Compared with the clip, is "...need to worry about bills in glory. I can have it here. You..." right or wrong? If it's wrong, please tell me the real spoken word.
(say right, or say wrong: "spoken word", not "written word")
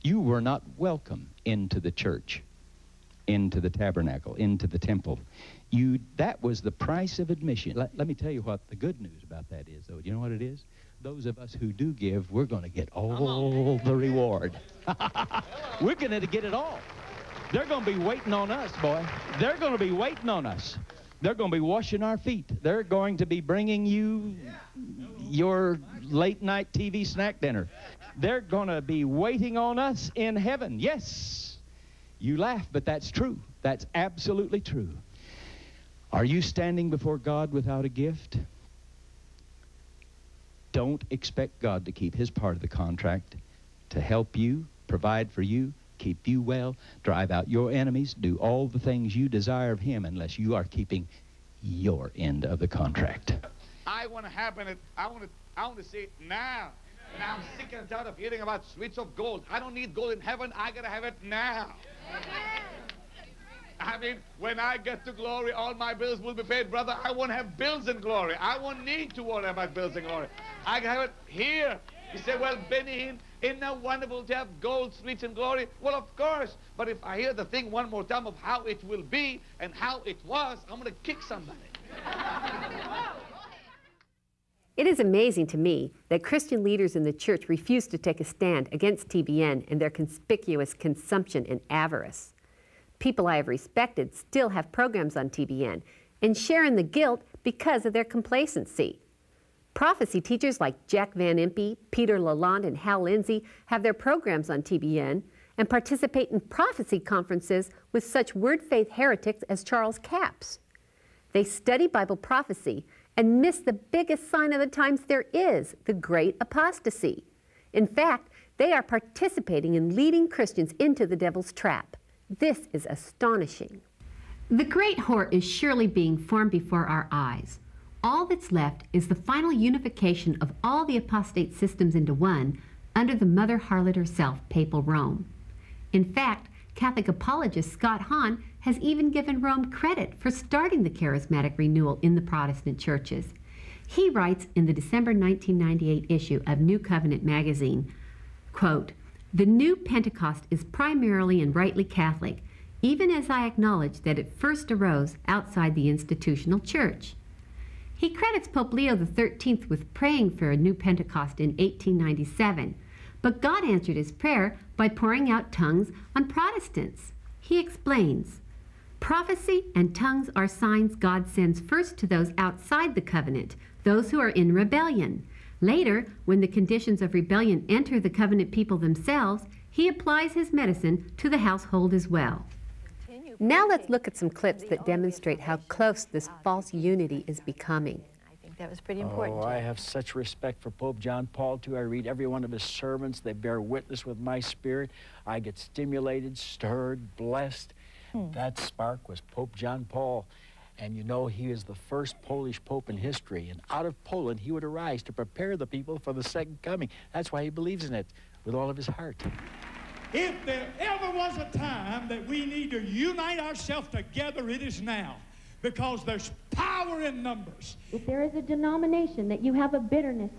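right.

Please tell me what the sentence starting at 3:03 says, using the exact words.
Now let's look at some clips that demonstrate how close this false unity is becoming.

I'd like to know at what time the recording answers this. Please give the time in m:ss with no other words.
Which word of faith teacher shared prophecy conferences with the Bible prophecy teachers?
1:49.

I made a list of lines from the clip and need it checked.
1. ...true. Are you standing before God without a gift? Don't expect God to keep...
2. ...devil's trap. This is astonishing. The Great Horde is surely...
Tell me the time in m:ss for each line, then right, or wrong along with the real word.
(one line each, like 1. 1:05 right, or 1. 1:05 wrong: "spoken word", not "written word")
1. 0:34 right
2. 2:01 right.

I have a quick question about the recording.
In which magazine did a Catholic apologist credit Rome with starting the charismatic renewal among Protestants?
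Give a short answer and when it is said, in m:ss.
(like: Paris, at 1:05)
New Covenant, at 2:26.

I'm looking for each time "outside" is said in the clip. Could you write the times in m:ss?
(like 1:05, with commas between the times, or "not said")
2:35, 2:52.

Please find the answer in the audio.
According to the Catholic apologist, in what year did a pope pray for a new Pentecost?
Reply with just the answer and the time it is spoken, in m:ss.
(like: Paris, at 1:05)
1897, at 2:41.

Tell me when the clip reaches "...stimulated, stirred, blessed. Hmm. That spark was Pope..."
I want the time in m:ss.
3:15.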